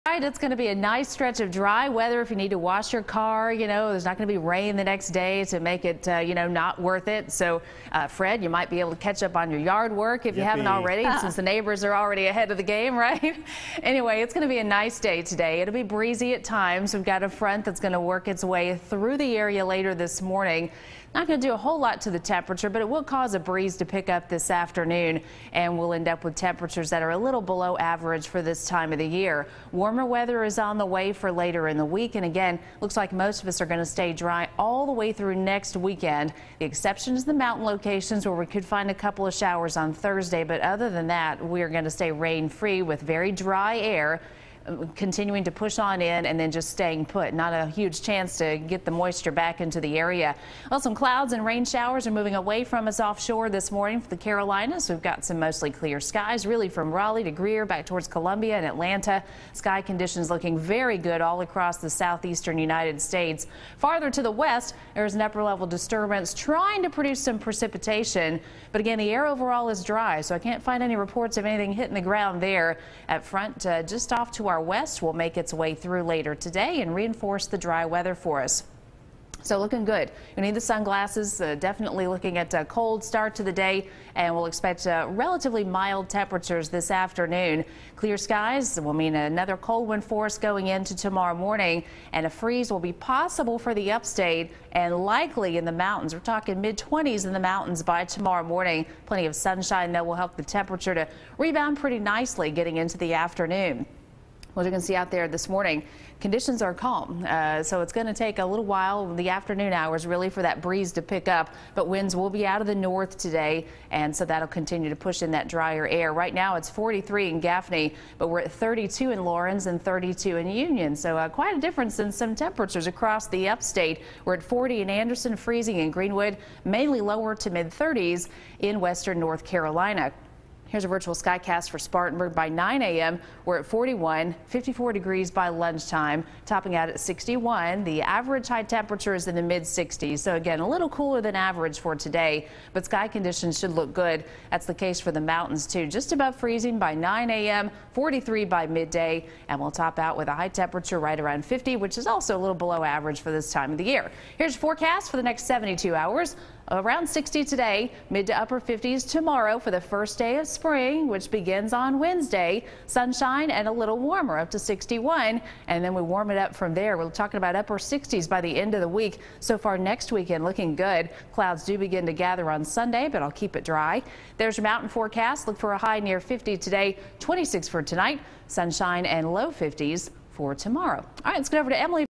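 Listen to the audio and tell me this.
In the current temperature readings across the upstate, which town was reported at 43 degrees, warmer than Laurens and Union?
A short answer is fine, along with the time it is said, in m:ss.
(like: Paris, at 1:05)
Gaffney, at 1:57.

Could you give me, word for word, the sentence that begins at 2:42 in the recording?
Sunshine and a little warmer up to 61, and then we warm it up from there.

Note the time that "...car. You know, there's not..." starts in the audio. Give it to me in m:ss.
0:03.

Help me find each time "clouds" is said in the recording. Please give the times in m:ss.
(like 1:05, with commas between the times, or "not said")
0:50, 2:51.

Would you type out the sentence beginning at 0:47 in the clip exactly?
Not a huge chance to get the moisture back into the area.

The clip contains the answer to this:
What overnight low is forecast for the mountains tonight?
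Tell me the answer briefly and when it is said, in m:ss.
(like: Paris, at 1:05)
26, at 2:57.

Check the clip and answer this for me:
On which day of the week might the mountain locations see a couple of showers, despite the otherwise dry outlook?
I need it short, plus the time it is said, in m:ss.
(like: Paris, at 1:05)
Thursday, at 0:39.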